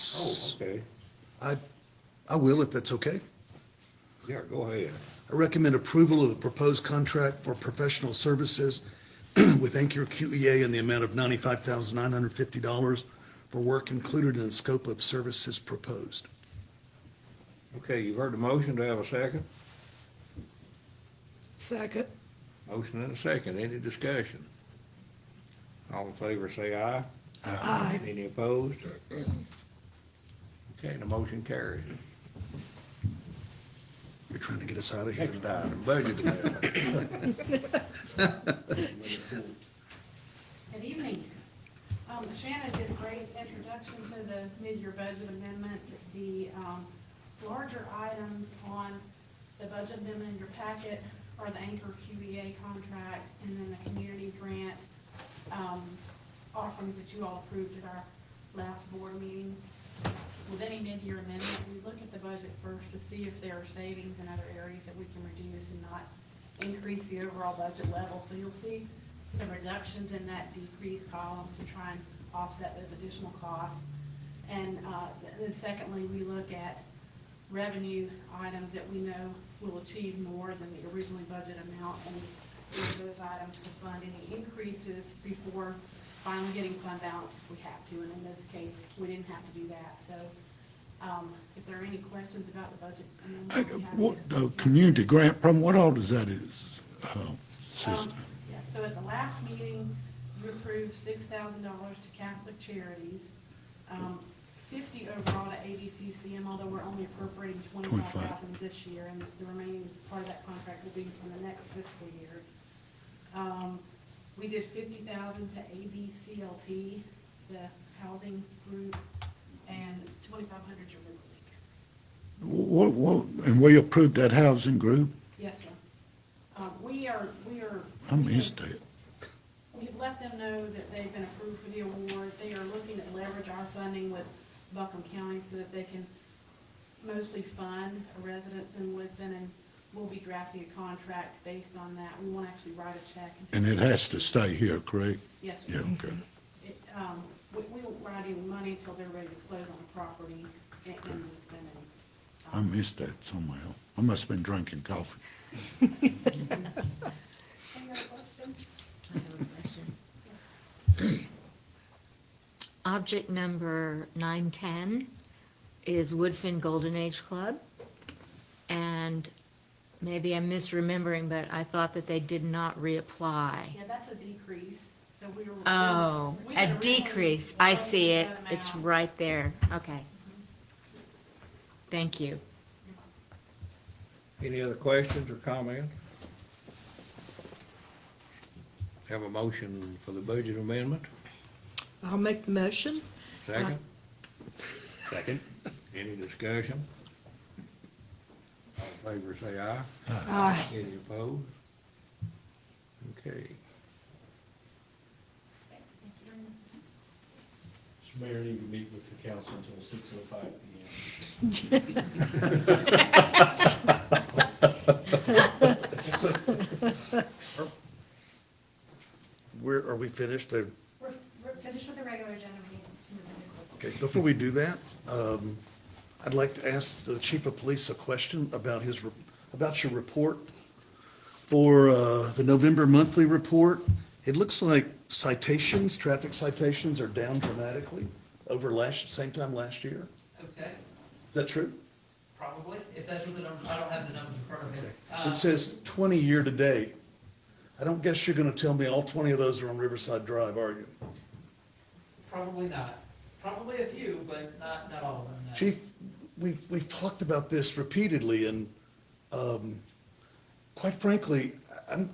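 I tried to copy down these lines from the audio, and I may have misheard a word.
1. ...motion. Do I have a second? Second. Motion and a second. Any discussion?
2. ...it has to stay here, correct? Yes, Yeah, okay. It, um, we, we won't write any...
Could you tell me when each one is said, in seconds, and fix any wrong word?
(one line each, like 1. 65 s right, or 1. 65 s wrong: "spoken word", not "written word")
1. 18 s right
2. 143 s right.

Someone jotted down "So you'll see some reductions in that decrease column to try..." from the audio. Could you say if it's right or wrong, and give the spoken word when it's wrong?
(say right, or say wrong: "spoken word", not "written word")
right.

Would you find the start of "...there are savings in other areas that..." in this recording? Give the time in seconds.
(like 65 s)
63 s.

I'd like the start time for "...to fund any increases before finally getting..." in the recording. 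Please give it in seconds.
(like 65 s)
83 s.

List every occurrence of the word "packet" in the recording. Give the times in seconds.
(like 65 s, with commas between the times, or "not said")
50 s.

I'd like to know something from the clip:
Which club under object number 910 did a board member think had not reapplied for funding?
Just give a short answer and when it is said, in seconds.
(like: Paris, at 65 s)
Woodfin Golden Age Club, at 166 s.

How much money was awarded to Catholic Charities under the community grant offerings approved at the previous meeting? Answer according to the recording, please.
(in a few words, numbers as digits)
$6,000.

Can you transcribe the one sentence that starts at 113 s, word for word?
Um, we did fifty thousand to ABCLT, the housing group, and twenty-five hundred to River League.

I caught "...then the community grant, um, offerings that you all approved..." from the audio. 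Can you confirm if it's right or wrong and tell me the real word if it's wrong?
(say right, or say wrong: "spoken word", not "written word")
right.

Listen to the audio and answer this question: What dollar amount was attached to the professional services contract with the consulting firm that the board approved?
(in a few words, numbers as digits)
$95,950.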